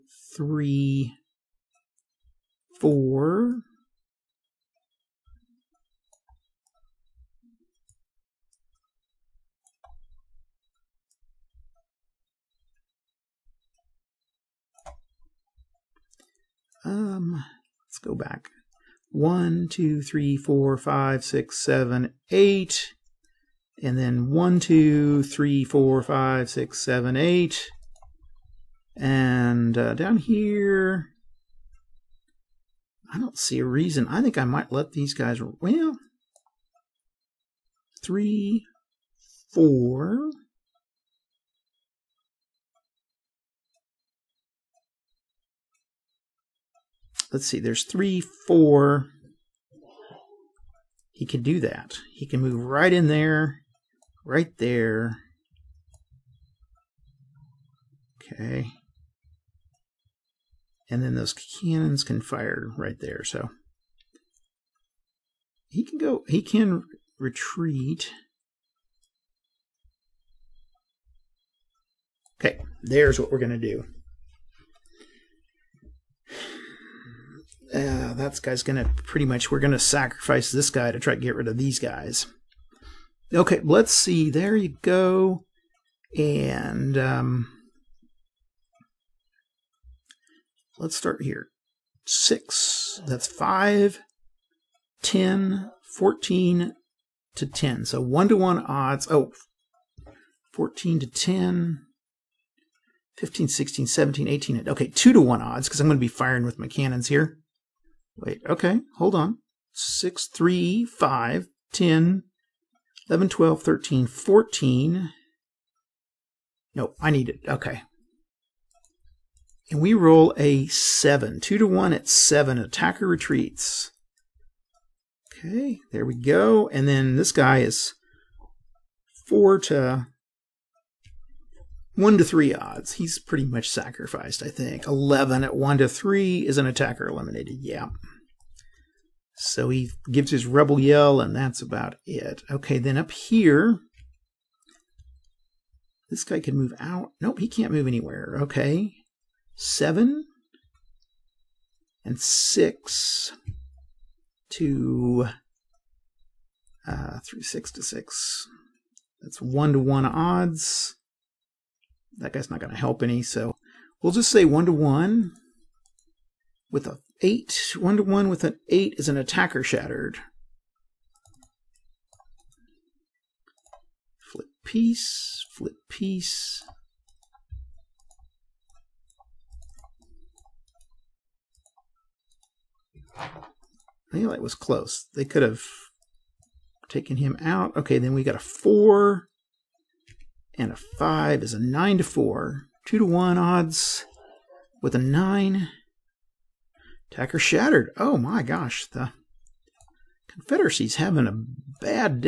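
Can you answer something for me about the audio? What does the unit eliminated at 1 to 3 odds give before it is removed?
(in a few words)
Rebel yell.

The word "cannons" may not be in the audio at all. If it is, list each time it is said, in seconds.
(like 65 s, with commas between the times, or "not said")
61 s, 106 s.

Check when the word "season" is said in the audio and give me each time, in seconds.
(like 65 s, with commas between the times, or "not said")
not said.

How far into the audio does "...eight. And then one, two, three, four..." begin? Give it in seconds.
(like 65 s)
22 s.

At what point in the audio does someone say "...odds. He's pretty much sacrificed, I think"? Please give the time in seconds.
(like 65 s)
132 s.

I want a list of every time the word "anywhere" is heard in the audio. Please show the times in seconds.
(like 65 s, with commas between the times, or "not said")
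147 s.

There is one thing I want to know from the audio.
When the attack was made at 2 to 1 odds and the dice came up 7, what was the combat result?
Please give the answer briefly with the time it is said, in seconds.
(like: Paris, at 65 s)
Attacker retreats, at 122 s.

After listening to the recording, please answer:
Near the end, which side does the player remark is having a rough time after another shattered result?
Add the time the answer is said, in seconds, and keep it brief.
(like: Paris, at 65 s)
The Confederacy, at 200 s.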